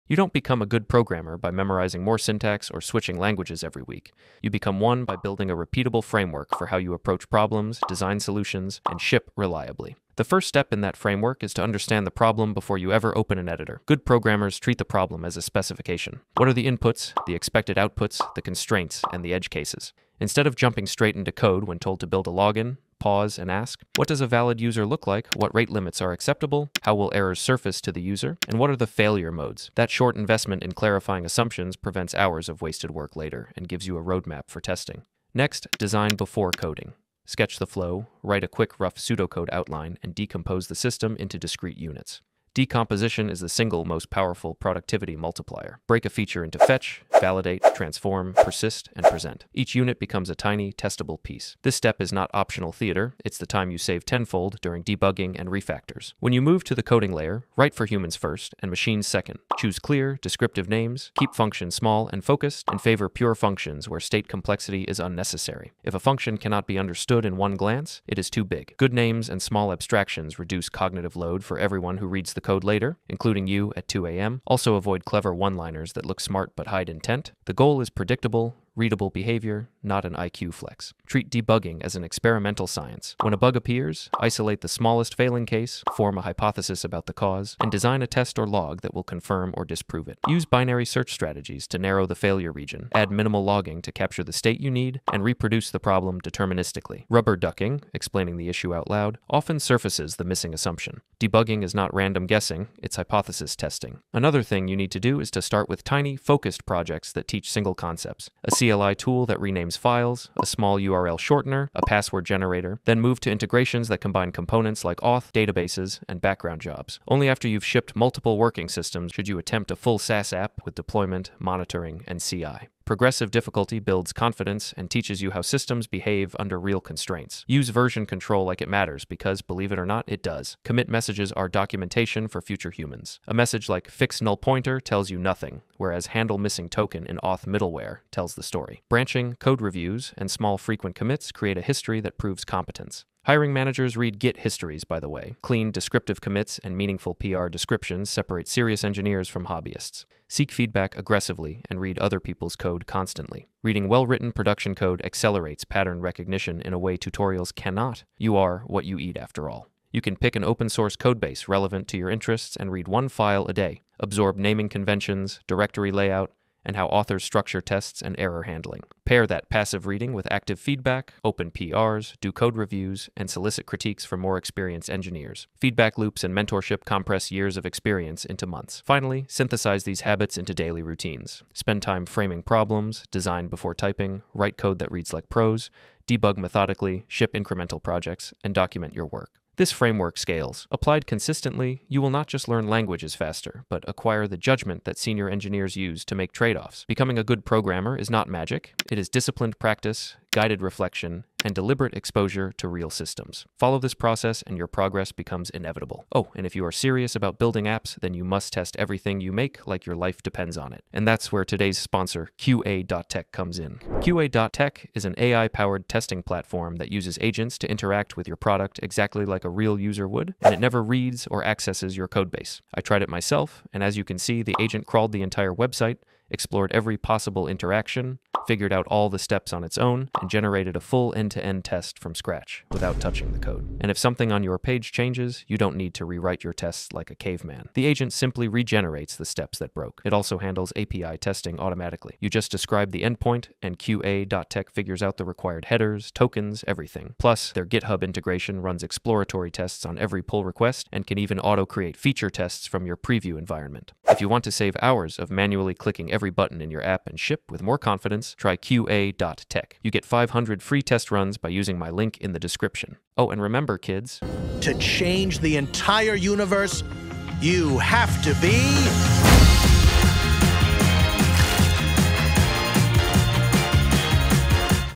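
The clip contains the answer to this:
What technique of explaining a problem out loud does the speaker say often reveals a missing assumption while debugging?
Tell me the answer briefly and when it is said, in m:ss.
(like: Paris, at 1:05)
Rubber ducking, at 1:37.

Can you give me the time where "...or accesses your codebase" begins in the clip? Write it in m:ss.
3:41.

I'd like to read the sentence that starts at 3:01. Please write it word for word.
Spend time framing problems, design before typing, write code that reads like prose, debug methodically, ship incremental projects, and document your work.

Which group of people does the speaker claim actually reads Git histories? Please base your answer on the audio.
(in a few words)
Hiring managers.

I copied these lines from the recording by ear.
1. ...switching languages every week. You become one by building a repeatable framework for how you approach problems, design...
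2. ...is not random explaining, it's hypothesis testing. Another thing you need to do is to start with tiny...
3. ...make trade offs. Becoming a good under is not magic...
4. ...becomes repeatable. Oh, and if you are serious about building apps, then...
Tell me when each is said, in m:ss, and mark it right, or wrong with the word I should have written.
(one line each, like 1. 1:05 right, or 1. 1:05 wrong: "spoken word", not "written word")
1. 0:02 right
2. 1:41 wrong: "guessing", not "explaining"
3. 3:16 wrong: "programmer", not "under"
4. 3:25 wrong: "inevitable", not "repeatable".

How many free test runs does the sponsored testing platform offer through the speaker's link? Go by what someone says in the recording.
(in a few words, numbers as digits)
500.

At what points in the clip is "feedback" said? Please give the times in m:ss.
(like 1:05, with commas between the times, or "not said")
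2:30, 2:50, 2:55.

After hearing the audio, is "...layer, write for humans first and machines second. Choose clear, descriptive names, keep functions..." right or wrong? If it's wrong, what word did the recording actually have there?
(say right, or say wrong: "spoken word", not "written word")
right.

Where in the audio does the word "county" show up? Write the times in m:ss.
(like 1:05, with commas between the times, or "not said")
not said.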